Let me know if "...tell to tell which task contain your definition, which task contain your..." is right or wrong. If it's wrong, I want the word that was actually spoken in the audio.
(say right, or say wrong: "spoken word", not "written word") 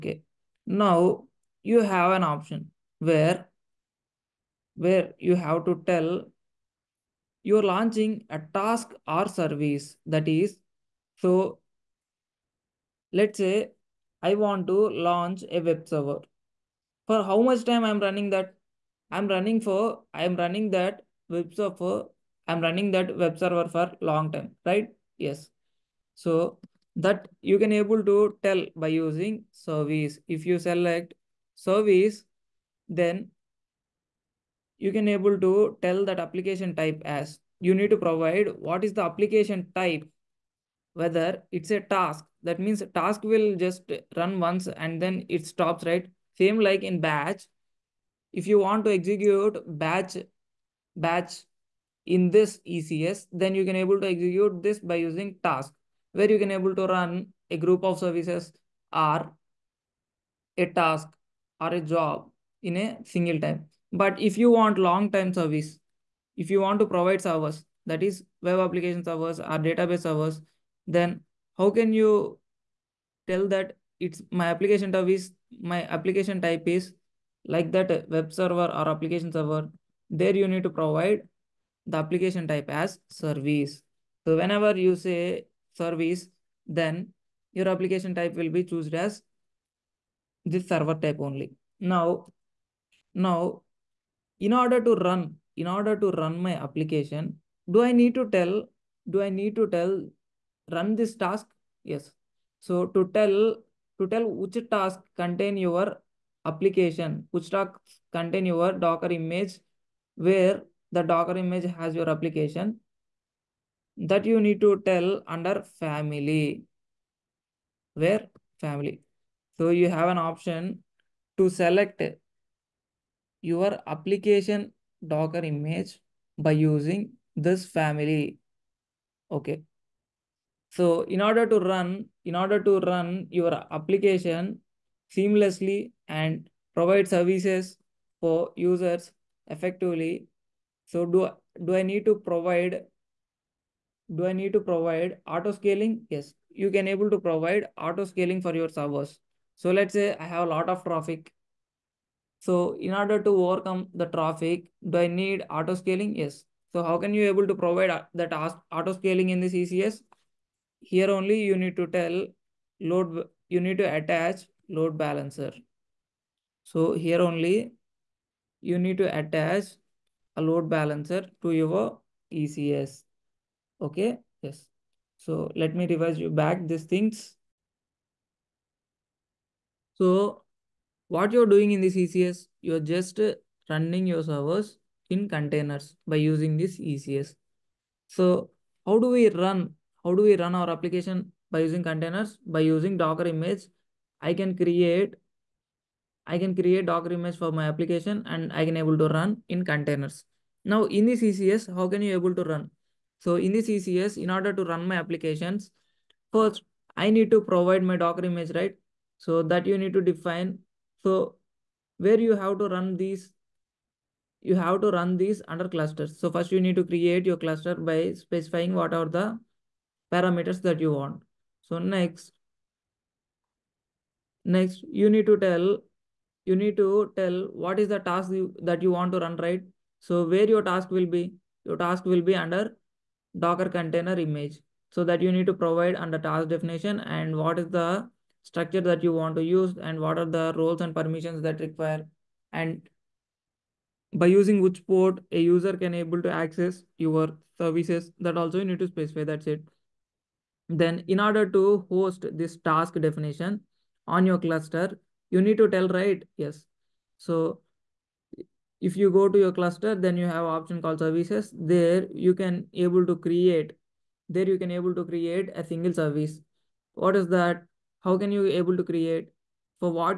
wrong: "application", not "definition".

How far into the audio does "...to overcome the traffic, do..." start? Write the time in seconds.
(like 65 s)
153 s.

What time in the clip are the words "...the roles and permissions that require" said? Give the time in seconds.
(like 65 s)
240 s.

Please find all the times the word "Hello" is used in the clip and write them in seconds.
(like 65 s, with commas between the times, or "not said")
not said.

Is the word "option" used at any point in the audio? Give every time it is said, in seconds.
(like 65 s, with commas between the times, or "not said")
2 s, 120 s, 260 s.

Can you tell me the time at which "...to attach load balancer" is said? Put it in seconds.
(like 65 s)
163 s.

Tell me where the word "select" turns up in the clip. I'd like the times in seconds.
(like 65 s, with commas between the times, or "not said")
30 s, 121 s.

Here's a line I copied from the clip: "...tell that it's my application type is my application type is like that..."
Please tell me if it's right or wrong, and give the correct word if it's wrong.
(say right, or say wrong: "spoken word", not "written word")
right.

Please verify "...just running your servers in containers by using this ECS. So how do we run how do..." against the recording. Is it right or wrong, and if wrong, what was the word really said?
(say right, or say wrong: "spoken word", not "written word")
right.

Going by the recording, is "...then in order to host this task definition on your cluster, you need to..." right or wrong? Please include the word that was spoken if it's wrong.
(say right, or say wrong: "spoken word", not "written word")
right.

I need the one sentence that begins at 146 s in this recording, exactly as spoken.
Yes, you can able to provide auto scaling for your servers.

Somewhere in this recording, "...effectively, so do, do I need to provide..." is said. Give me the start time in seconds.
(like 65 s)
139 s.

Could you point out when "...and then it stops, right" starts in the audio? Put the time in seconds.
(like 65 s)
44 s.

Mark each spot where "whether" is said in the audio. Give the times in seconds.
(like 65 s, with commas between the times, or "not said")
40 s.